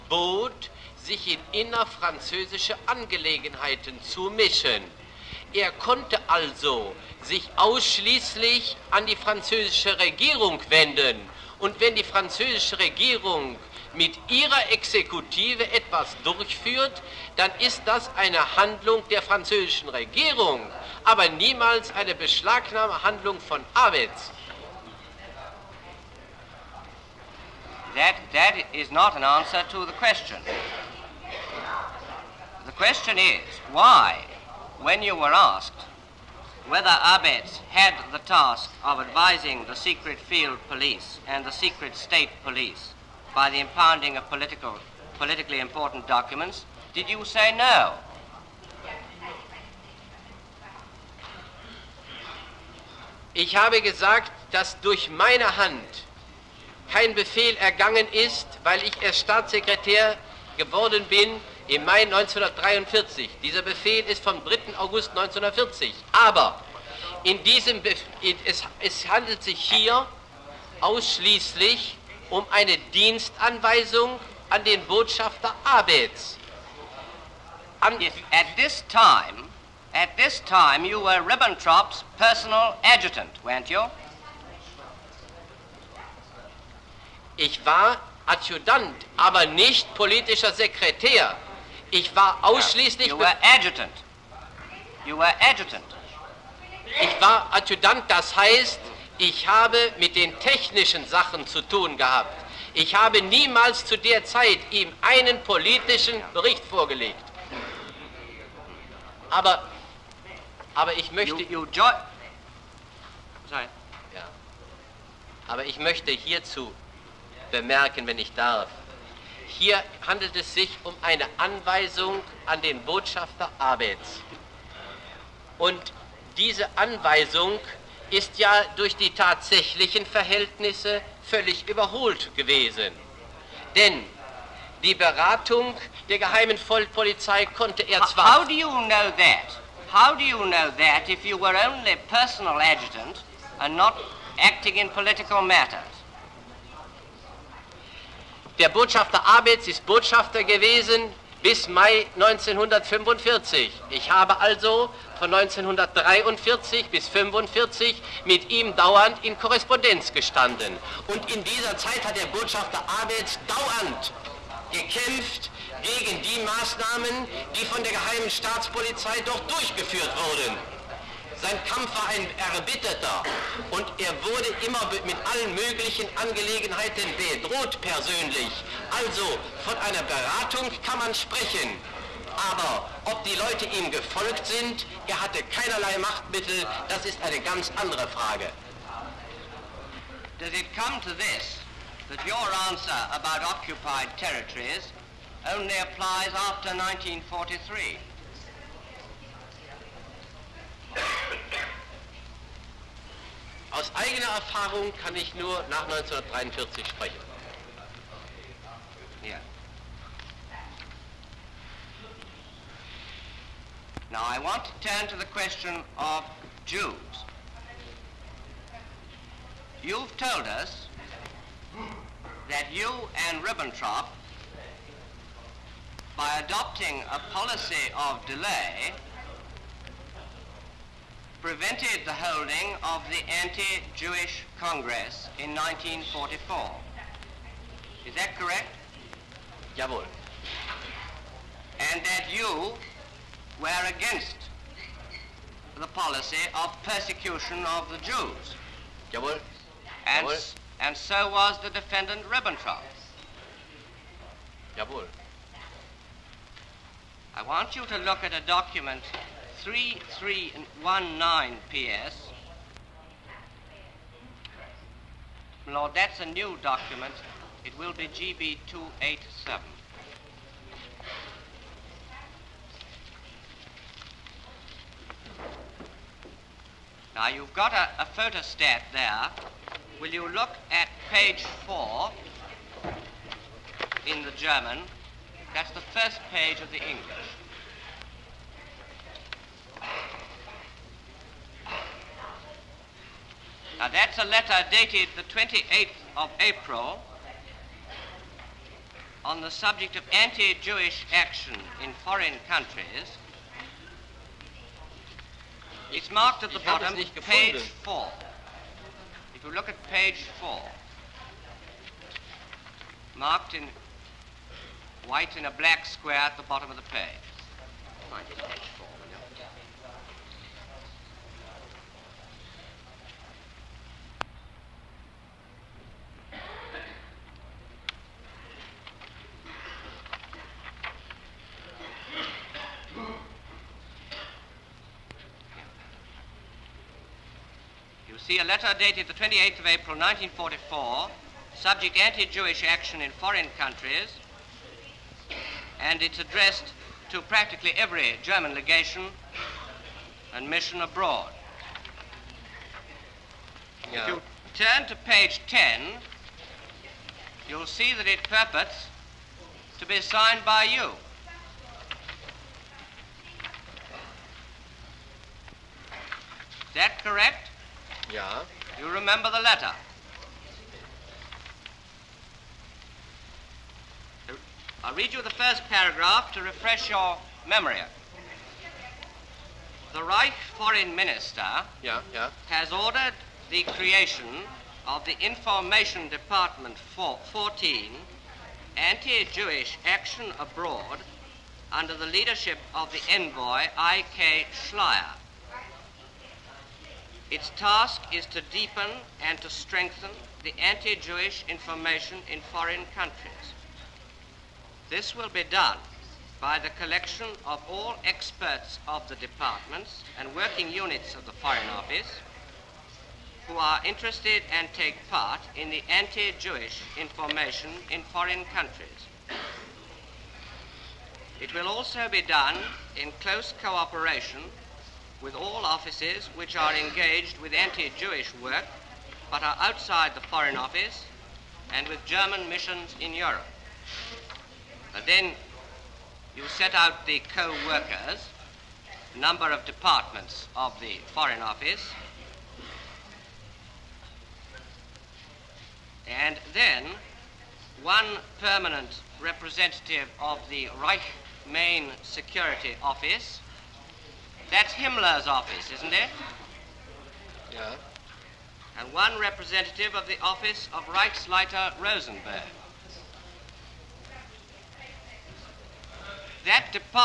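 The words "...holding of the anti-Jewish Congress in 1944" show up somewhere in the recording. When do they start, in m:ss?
3:52.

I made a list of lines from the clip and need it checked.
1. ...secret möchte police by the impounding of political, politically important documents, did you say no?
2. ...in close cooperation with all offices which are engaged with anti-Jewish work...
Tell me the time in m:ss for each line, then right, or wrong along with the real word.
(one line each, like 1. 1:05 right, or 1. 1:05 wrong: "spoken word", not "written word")
1. 0:41 wrong: "state", not "möchte"
2. 7:02 right.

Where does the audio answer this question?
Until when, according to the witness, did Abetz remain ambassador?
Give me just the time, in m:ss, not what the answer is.
2:31.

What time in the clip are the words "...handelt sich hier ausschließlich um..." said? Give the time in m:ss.
1:09.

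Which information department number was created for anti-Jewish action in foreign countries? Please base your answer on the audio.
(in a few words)
14.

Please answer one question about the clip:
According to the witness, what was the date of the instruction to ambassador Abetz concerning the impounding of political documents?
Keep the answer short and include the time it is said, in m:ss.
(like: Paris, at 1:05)
3 August 1940, at 1:04.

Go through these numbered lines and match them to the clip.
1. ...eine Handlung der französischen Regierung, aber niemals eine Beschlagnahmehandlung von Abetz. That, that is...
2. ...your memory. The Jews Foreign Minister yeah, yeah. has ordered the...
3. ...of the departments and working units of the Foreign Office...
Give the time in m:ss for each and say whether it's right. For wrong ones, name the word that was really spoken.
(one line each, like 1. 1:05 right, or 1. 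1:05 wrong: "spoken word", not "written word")
1. 0:18 right
2. 6:16 wrong: "Reich", not "Jews"
3. 6:48 right.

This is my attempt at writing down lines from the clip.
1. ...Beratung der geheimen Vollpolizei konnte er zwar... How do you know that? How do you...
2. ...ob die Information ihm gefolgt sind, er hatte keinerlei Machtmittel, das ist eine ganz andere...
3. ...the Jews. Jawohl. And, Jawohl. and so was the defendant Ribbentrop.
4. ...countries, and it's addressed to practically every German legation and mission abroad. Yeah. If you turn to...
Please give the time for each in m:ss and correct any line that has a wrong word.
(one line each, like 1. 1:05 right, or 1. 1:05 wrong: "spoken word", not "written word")
1. 2:14 right
2. 3:03 wrong: "Leute", not "Information"
3. 4:07 right
4. 5:43 right.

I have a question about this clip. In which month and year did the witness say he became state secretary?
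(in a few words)
May 1943.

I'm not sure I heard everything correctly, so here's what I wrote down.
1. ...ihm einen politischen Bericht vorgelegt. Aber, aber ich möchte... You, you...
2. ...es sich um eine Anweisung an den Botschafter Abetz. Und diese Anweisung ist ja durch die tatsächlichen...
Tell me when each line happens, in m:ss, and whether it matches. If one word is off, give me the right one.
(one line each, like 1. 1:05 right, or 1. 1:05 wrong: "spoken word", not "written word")
1. 1:44 right
2. 2:00 right.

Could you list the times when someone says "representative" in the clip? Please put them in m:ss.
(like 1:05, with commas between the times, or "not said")
7:29, 7:39.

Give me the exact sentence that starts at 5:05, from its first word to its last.
It's marked at the bottom, page four.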